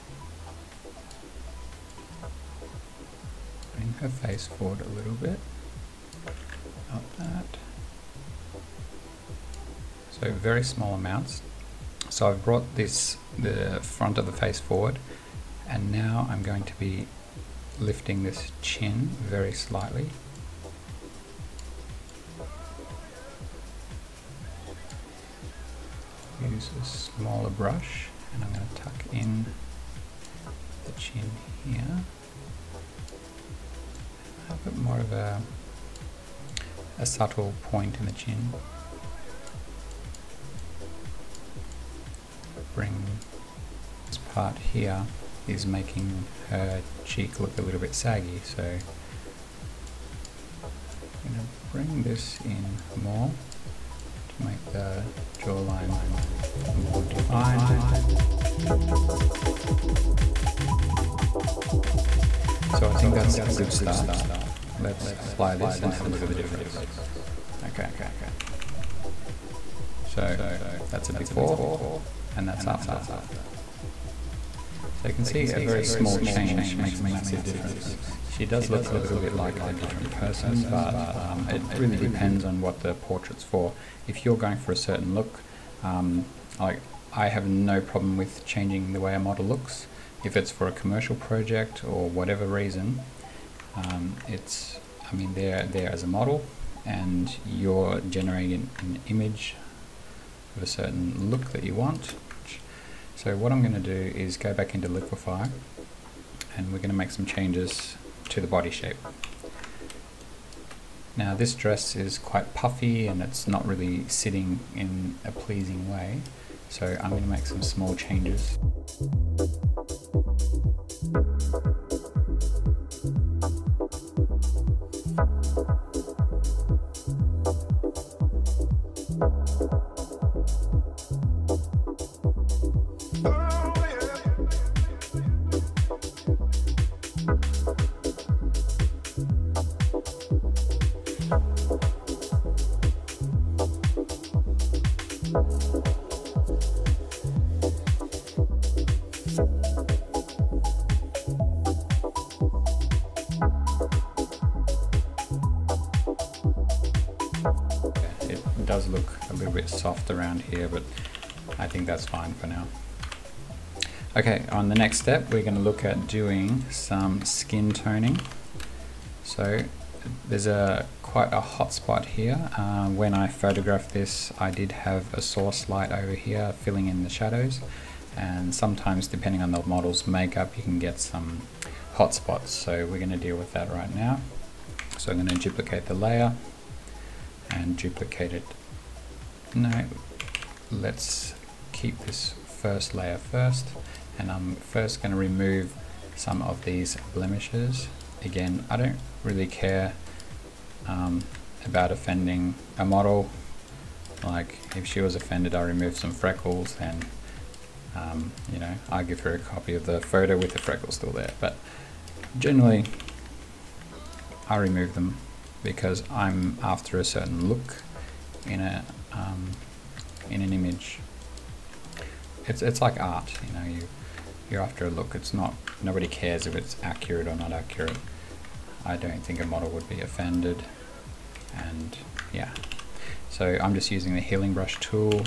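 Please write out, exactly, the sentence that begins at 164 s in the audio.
Okay, on the next step, we're gonna look at doing some skin toning.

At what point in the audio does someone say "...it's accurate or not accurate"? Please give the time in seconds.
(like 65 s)
226 s.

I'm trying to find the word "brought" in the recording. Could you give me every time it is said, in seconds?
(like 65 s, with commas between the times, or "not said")
12 s.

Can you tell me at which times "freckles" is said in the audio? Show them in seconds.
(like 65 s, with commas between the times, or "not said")
206 s, 210 s.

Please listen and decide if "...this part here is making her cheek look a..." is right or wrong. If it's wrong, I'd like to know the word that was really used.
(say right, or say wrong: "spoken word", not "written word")
right.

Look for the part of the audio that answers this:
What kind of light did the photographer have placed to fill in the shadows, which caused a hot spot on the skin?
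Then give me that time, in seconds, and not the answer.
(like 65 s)
175 s.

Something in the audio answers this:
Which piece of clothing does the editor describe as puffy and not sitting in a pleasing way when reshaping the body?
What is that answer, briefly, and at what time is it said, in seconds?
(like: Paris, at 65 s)
dress, at 111 s.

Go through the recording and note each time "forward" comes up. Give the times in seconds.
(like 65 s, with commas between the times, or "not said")
4 s, 14 s.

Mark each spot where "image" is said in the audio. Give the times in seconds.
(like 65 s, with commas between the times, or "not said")
99 s, 220 s.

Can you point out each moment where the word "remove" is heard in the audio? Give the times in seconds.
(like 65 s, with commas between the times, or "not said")
195 s, 205 s, 214 s.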